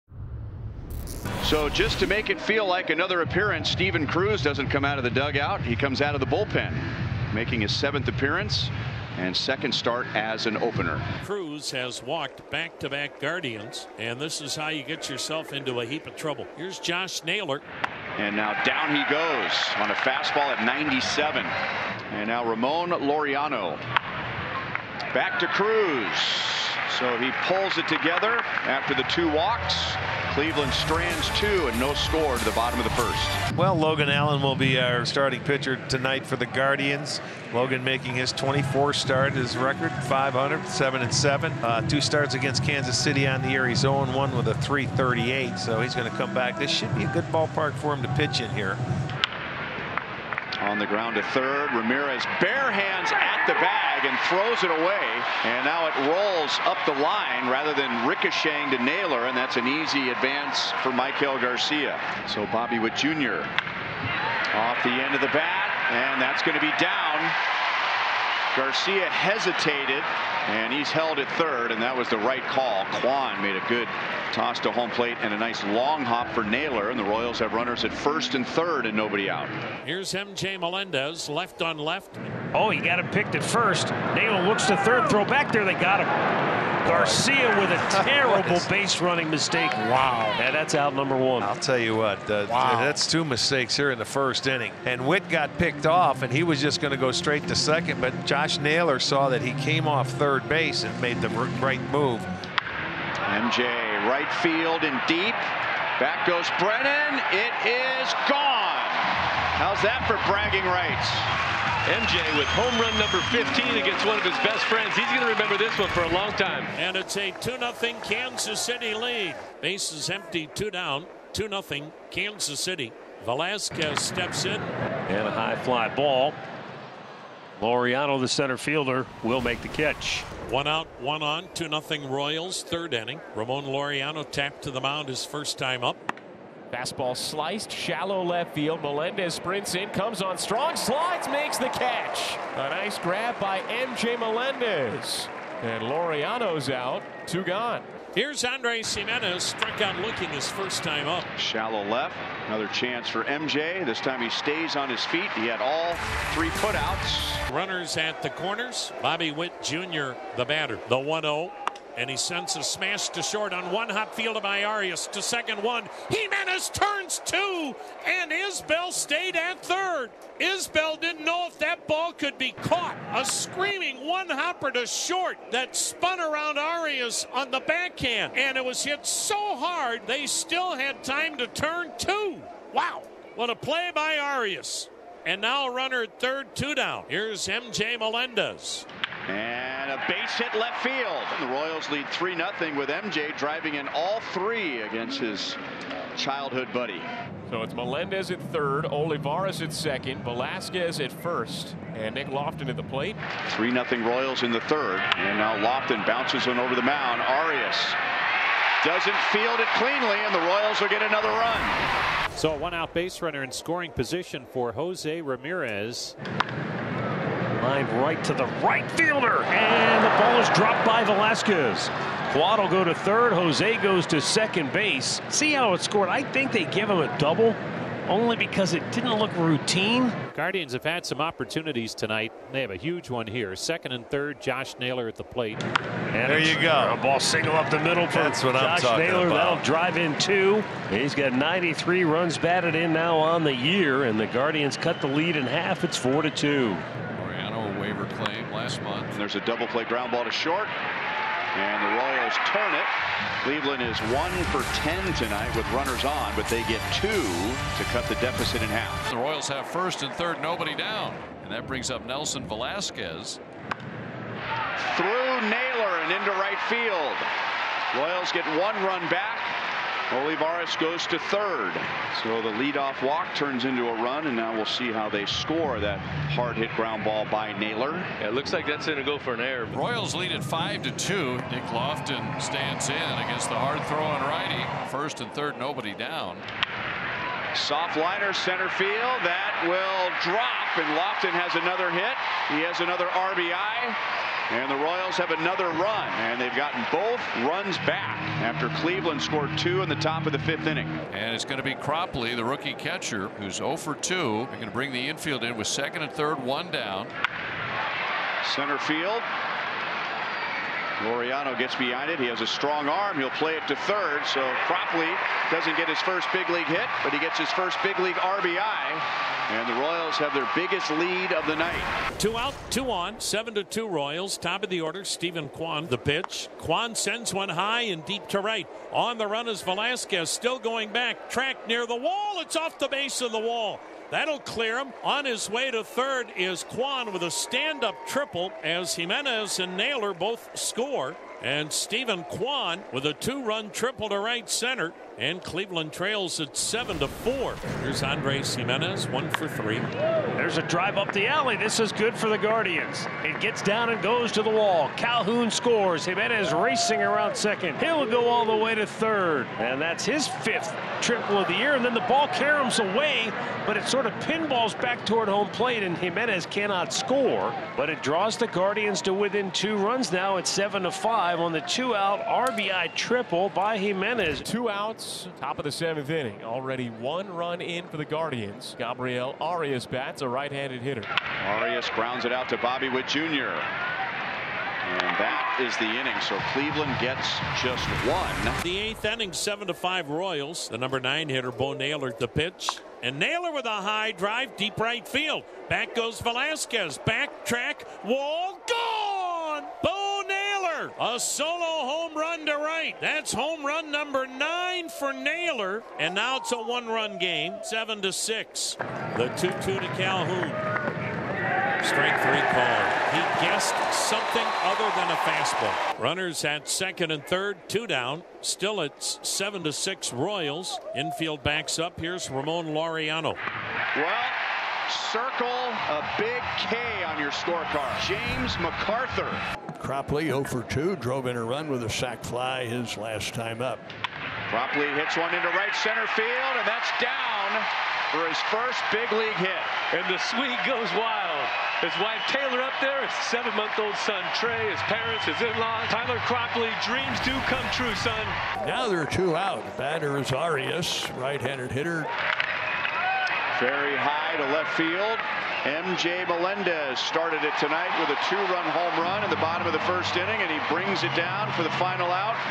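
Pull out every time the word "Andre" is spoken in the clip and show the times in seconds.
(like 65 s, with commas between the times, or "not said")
148 s, 348 s.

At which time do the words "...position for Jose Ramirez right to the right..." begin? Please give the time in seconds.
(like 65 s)
213 s.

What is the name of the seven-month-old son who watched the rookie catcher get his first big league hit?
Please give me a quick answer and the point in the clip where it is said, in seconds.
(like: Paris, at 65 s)
Trey, at 444 s.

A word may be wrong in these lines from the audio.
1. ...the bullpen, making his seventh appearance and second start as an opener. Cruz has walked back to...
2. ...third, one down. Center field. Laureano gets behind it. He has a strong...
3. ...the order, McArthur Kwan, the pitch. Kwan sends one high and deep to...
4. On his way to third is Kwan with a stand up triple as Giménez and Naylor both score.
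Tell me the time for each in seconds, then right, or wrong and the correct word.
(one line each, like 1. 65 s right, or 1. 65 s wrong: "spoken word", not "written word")
1. 6 s right
2. 306 s right
3. 324 s wrong: "Steven", not "McArthur"
4. 335 s right.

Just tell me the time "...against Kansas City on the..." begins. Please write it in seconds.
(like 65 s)
42 s.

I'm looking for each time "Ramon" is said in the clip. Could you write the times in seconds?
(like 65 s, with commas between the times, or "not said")
22 s, 133 s, 422 s.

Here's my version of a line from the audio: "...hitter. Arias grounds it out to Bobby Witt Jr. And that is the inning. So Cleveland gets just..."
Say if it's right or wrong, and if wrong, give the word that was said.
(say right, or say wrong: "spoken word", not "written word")
right.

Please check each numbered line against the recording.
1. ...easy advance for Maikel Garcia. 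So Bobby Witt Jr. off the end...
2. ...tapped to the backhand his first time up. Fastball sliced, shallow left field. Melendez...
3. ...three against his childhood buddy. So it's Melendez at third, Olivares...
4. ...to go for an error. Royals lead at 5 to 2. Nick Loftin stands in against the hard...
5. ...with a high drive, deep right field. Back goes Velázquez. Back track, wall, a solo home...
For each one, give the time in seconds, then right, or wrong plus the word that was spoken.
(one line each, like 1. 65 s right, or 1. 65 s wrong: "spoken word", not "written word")
1. 59 s right
2. 134 s wrong: "mound", not "backhand"
3. 194 s right
4. 278 s right
5. 393 s right.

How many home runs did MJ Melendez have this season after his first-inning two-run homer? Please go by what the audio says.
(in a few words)
15.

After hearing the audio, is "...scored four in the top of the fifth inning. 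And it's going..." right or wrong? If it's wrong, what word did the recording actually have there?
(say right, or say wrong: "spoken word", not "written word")
wrong: "two", not "four".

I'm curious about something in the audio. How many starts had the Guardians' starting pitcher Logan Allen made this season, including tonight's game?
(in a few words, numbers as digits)
24.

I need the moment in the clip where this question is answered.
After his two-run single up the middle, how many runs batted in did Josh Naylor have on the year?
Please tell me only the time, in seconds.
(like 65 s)
241 s.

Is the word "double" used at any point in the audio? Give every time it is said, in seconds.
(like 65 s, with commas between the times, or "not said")
227 s, 249 s.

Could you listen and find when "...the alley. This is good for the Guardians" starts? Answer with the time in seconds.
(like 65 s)
351 s.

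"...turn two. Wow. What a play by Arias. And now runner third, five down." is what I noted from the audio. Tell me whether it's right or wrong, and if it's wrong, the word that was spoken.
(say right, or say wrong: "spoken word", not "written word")
wrong: "two", not "five".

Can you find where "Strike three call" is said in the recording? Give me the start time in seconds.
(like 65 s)
411 s.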